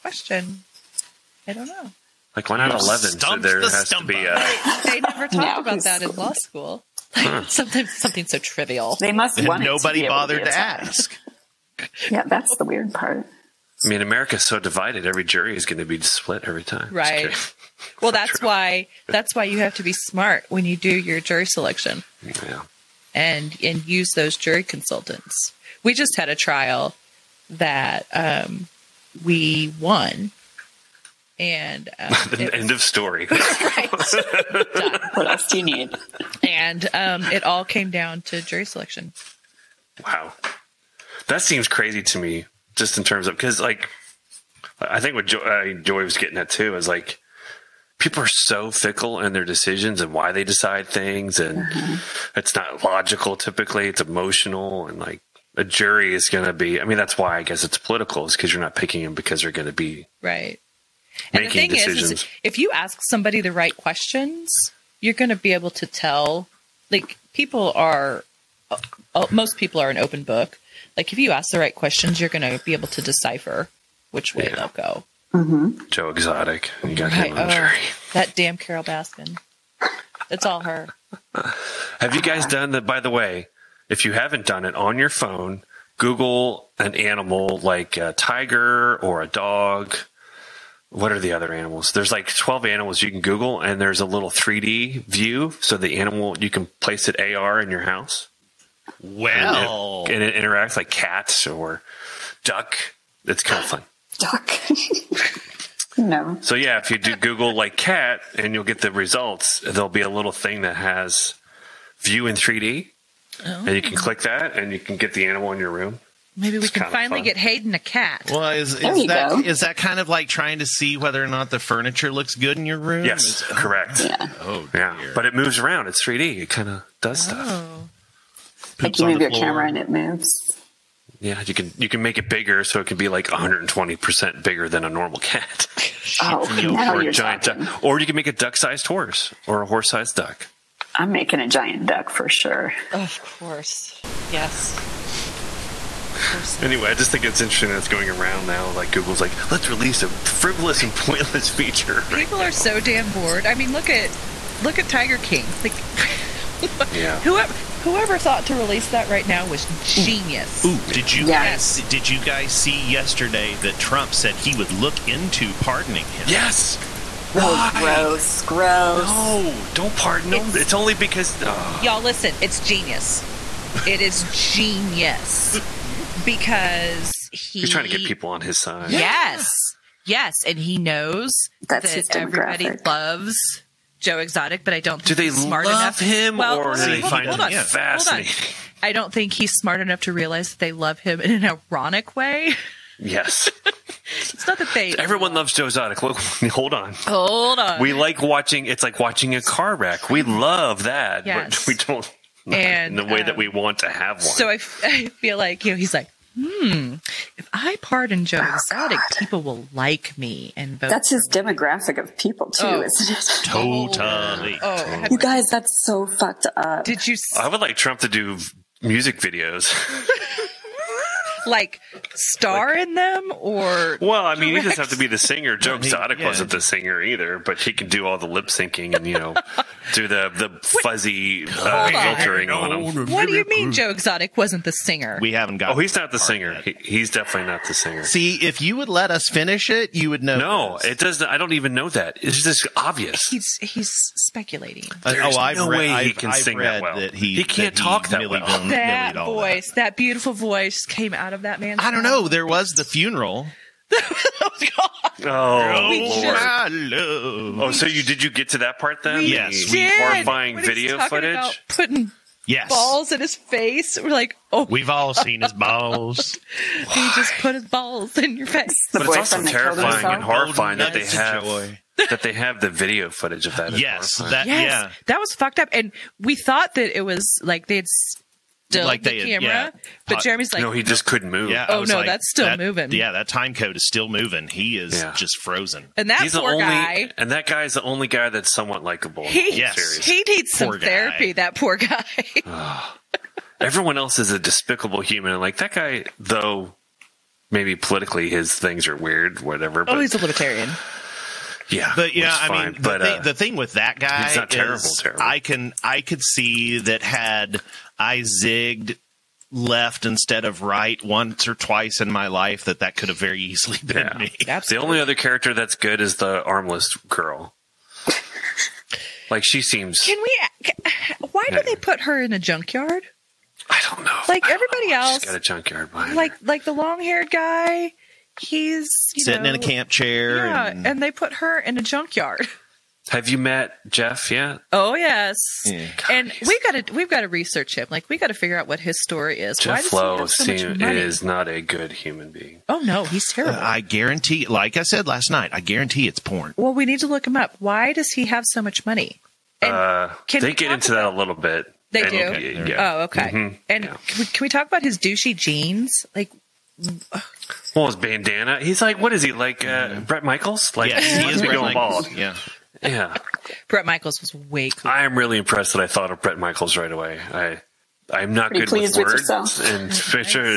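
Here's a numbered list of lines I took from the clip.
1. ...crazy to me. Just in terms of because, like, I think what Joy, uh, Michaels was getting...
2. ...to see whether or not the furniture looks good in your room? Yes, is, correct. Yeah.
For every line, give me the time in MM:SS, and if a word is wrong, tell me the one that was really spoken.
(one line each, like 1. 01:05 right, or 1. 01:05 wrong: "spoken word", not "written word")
1. 00:41 wrong: "Joy", not "Michaels"
2. 02:00 right.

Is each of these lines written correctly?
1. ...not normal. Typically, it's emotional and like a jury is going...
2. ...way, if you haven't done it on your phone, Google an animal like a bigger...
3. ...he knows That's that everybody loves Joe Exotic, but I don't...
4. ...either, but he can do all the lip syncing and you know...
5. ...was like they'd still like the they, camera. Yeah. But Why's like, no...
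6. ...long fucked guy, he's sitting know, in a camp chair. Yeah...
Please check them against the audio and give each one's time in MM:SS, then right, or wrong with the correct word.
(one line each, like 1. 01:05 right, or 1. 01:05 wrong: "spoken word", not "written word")
1. 00:52 wrong: "logical", not "normal"
2. 01:23 wrong: "tiger", not "bigger"
3. 03:00 right
4. 03:47 right
5. 04:37 wrong: "Jeremy", not "Why"
6. 05:26 wrong: "haired", not "fucked".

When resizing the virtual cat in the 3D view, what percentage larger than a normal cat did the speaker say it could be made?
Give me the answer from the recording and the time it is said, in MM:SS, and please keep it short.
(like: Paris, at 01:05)
120 percent, at 02:13.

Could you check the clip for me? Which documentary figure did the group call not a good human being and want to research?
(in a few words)
Jeff Lowe.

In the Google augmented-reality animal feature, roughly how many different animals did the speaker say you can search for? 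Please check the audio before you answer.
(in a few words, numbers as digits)
12.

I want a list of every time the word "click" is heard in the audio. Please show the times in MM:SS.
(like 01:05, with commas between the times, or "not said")
01:53.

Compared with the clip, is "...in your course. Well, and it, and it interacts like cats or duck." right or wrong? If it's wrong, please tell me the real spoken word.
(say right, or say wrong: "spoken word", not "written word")
wrong: "house", not "course".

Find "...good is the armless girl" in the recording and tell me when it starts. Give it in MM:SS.
05:15.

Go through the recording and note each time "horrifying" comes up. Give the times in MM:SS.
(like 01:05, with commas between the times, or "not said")
04:19, 04:30.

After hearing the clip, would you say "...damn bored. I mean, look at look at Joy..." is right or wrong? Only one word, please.
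wrong.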